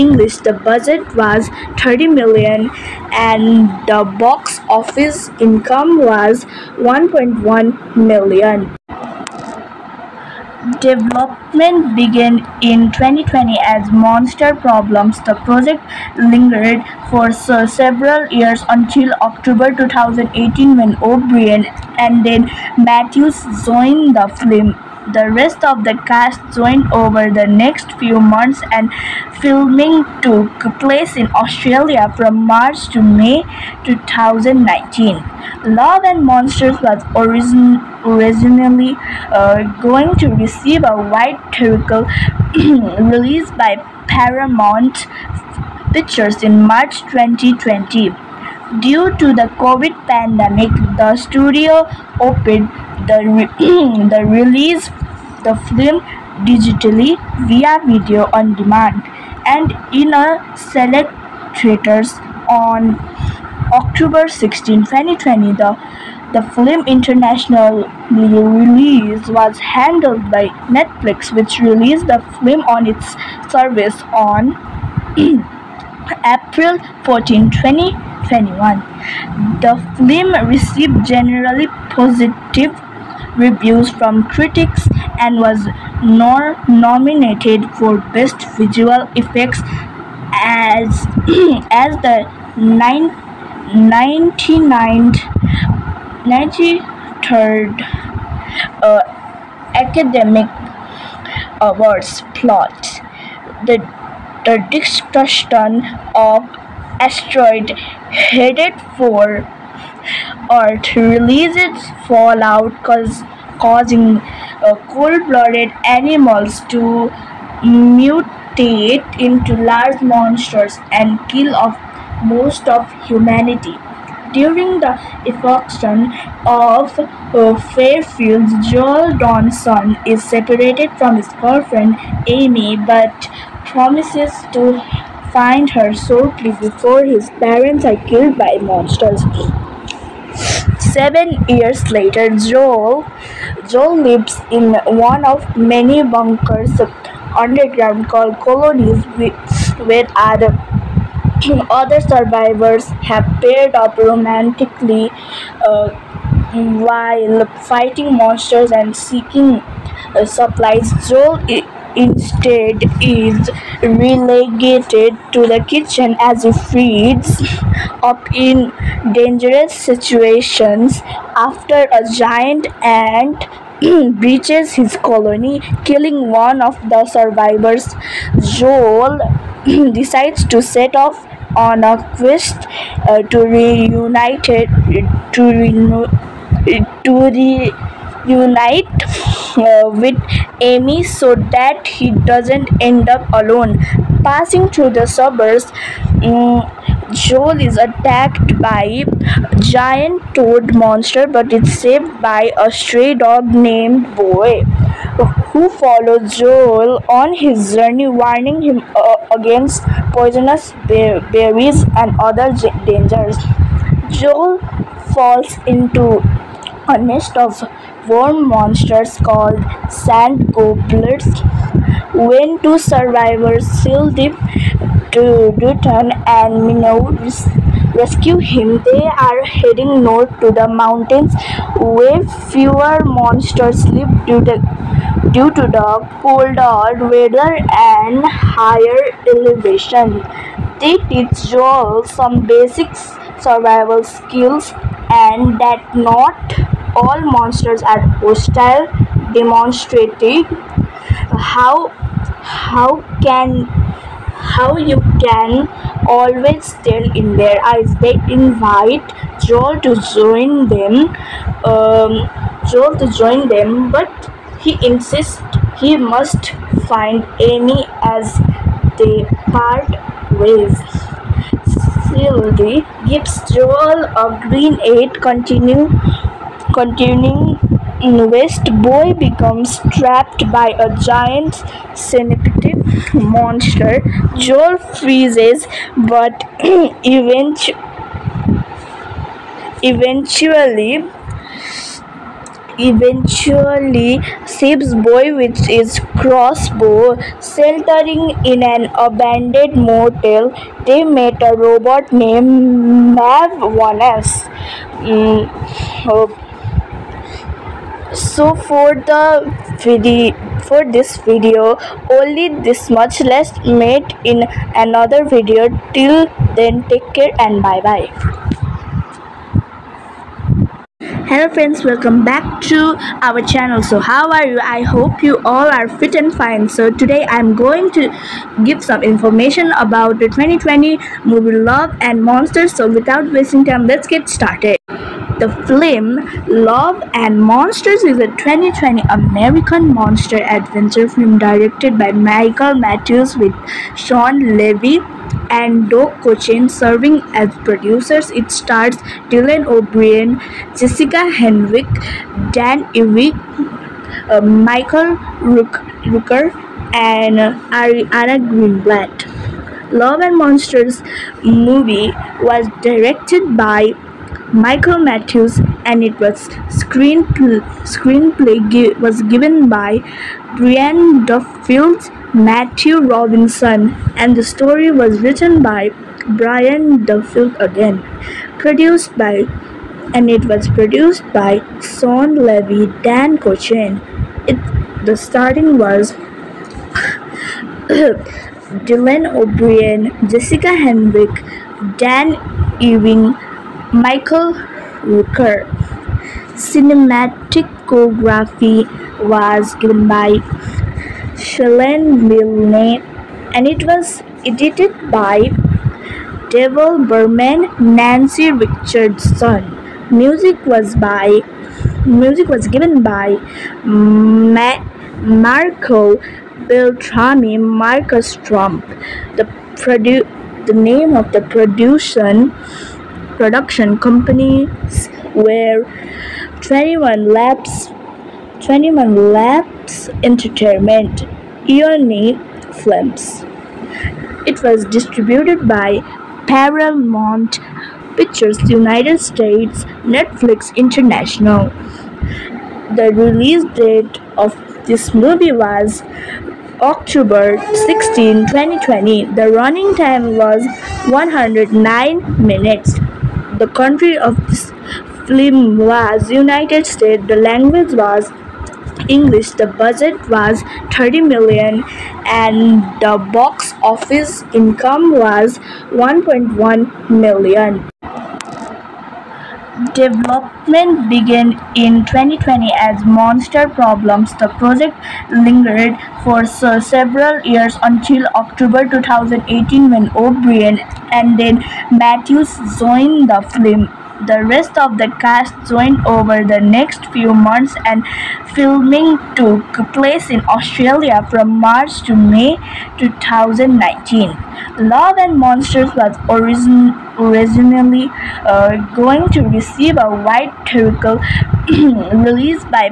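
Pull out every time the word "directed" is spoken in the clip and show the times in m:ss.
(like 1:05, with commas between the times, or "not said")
5:41, 6:02.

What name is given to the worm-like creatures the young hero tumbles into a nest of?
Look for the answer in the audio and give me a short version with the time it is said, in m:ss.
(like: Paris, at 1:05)
sand gobblers, at 3:39.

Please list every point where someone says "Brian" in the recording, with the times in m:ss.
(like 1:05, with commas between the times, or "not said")
6:10, 6:16.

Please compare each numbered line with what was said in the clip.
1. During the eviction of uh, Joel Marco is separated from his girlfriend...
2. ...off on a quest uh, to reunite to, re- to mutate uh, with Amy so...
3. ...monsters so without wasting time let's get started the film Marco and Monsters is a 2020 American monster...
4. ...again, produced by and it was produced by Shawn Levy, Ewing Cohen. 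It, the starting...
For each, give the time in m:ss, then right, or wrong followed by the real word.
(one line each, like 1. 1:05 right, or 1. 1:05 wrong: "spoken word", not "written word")
1. 2:04 wrong: "Dawson", not "Marco"
2. 3:00 wrong: "reunite", not "mutate"
3. 5:32 wrong: "Love", not "Marco"
4. 6:17 wrong: "Dan", not "Ewing".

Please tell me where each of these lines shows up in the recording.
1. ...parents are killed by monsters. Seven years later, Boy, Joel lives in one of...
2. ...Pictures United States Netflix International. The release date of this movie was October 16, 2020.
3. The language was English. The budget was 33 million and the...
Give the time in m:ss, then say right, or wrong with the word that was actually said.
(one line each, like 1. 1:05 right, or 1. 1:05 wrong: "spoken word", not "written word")
1. 2:17 wrong: "Joel", not "Boy"
2. 7:18 right
3. 7:37 wrong: "30", not "33".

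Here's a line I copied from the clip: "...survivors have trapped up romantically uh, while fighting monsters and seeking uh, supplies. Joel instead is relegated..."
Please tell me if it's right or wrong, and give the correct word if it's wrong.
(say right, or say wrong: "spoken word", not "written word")
wrong: "paired", not "trapped".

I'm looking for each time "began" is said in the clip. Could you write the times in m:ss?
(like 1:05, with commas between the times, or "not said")
0:11, 7:51.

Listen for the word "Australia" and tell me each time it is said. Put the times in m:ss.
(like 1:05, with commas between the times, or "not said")
0:31, 8:10.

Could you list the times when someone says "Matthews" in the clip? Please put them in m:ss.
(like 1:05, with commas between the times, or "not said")
0:22, 5:42, 6:04, 6:12, 8:01.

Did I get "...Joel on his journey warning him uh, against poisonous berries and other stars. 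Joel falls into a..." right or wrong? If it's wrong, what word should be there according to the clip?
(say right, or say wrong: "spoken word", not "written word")
wrong: "dangers", not "stars".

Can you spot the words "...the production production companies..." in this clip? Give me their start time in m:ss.
7:01.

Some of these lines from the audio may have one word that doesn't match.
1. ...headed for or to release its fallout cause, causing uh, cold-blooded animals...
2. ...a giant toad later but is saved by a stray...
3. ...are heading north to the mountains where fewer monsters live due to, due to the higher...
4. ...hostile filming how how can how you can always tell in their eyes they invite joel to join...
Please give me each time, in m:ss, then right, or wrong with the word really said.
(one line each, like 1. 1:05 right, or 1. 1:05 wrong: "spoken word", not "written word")
1. 1:48 right
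2. 3:19 wrong: "monster", not "later"
3. 3:49 wrong: "colder", not "higher"
4. 4:08 wrong: "demonstrating", not "filming".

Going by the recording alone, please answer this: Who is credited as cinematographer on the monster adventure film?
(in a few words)
Shalane Milne.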